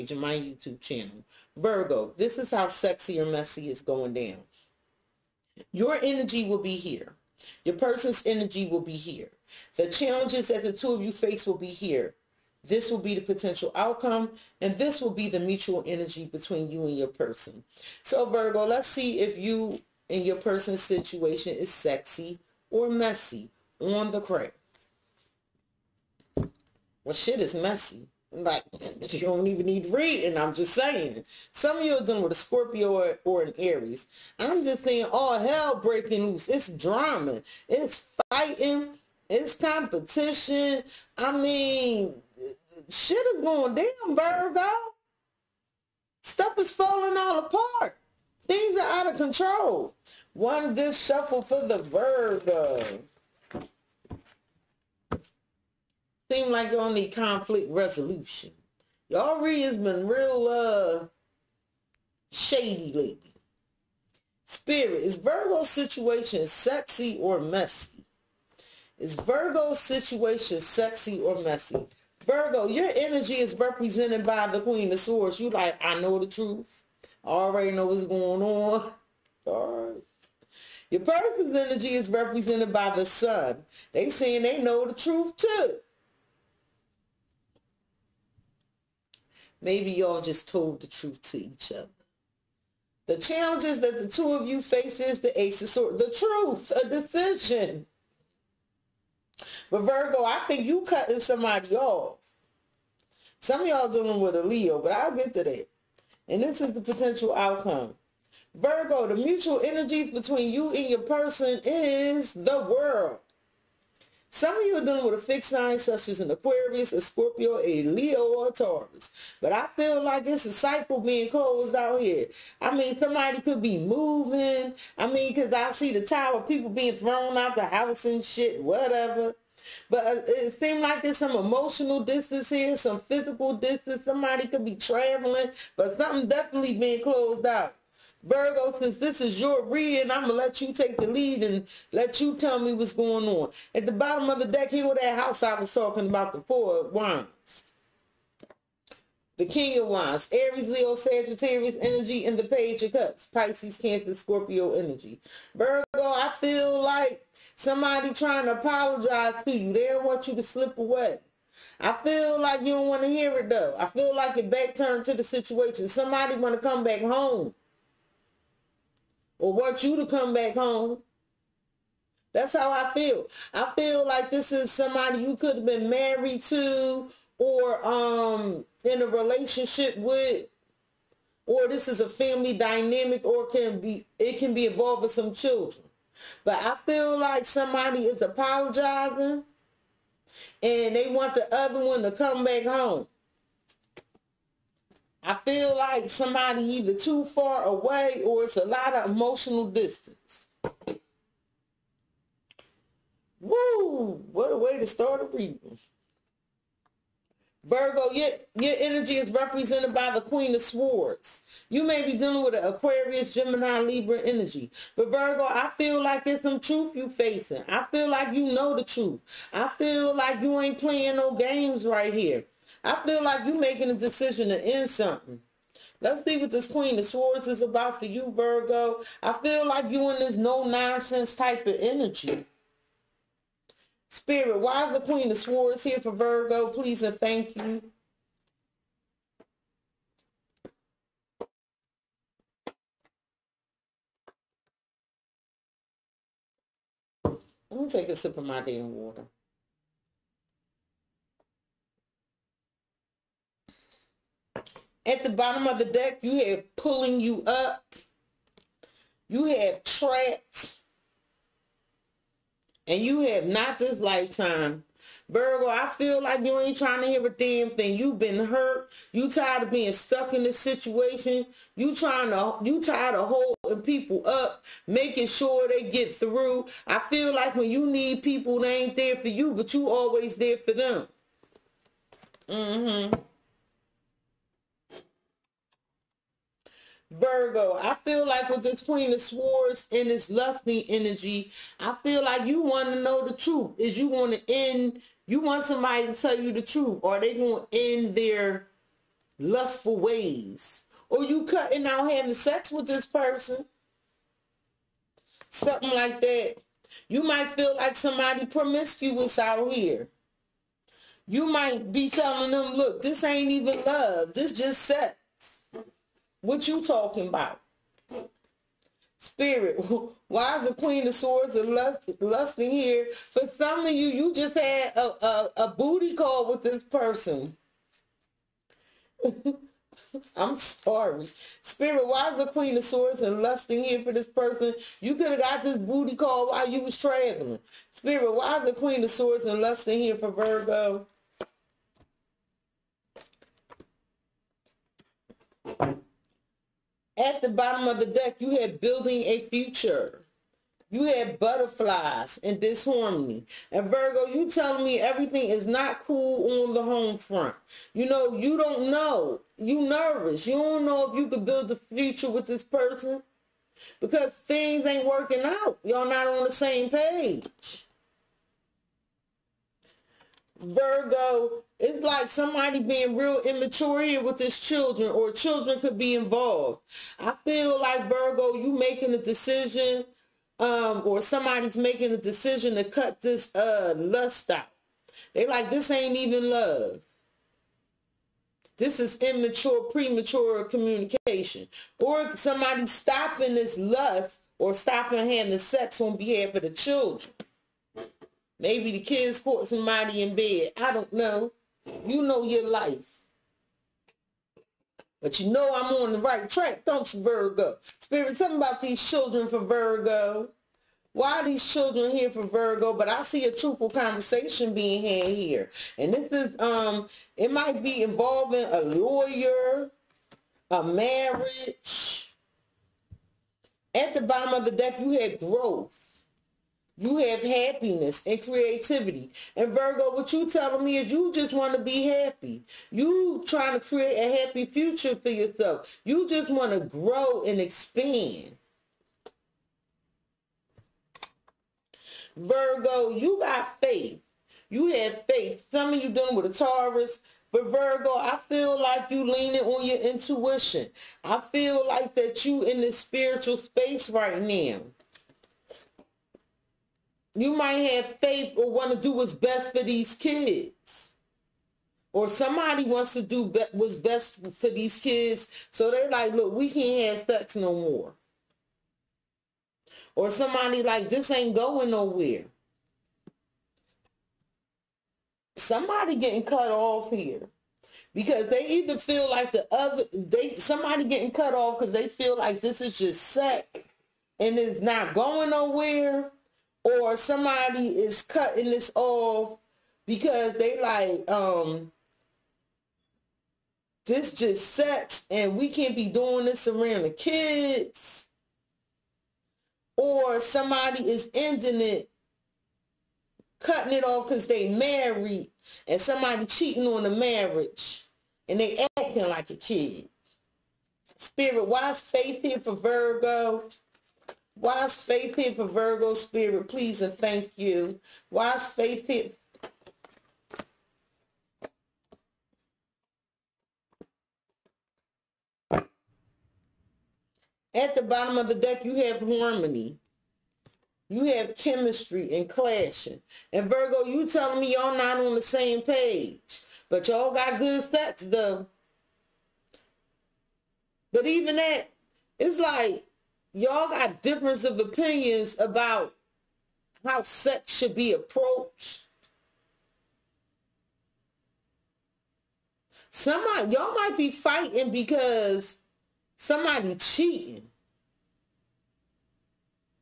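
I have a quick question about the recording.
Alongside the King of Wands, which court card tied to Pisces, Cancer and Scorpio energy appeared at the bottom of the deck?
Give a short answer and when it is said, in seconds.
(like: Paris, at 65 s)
Page of Cups, at 152 s.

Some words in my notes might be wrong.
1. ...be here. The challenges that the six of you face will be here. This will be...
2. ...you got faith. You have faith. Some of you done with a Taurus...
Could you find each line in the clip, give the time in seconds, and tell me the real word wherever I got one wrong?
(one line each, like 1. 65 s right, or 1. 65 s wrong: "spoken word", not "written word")
1. 8 s wrong: "two", not "six"
2. 443 s right.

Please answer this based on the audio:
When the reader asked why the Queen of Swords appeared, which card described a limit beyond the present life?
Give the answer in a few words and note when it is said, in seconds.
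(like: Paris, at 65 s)
Not this lifetime, at 263 s.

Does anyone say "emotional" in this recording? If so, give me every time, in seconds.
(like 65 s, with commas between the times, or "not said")
131 s, 199 s.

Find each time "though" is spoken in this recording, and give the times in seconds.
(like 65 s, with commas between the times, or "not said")
163 s, 538 s.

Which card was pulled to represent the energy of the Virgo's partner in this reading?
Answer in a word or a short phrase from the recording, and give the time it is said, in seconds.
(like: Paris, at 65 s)
The Sun, at 82 s.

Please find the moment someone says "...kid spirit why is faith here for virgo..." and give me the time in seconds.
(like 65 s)
509 s.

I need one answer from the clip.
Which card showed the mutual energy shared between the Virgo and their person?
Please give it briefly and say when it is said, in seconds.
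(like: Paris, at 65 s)
The World, at 112 s.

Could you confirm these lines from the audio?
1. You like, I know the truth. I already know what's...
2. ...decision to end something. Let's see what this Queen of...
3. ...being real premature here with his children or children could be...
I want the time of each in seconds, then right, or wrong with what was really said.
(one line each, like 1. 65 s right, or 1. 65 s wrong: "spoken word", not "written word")
1. 75 s right
2. 223 s right
3. 372 s wrong: "immature", not "premature".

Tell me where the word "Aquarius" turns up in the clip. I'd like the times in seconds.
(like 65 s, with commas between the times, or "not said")
116 s, 212 s.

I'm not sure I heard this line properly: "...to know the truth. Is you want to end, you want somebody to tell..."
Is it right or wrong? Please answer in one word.
right.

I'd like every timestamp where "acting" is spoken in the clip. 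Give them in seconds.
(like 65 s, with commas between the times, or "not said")
508 s.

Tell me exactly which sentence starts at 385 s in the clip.
They like, this ain't even love.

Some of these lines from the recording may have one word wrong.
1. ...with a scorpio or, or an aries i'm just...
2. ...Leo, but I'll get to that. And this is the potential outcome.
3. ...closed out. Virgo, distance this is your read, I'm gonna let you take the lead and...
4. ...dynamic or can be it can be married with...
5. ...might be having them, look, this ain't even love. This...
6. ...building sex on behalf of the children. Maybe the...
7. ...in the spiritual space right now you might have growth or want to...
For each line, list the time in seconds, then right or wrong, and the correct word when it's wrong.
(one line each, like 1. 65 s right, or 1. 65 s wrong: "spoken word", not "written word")
1. 32 s right
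2. 104 s right
3. 137 s wrong: "since", not "distance"
4. 182 s wrong: "involved", not "married"
5. 311 s wrong: "telling", not "having"
6. 395 s wrong: "having", not "building"
7. 452 s wrong: "faith", not "growth".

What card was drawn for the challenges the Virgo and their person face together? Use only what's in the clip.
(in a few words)
Ace of Swords.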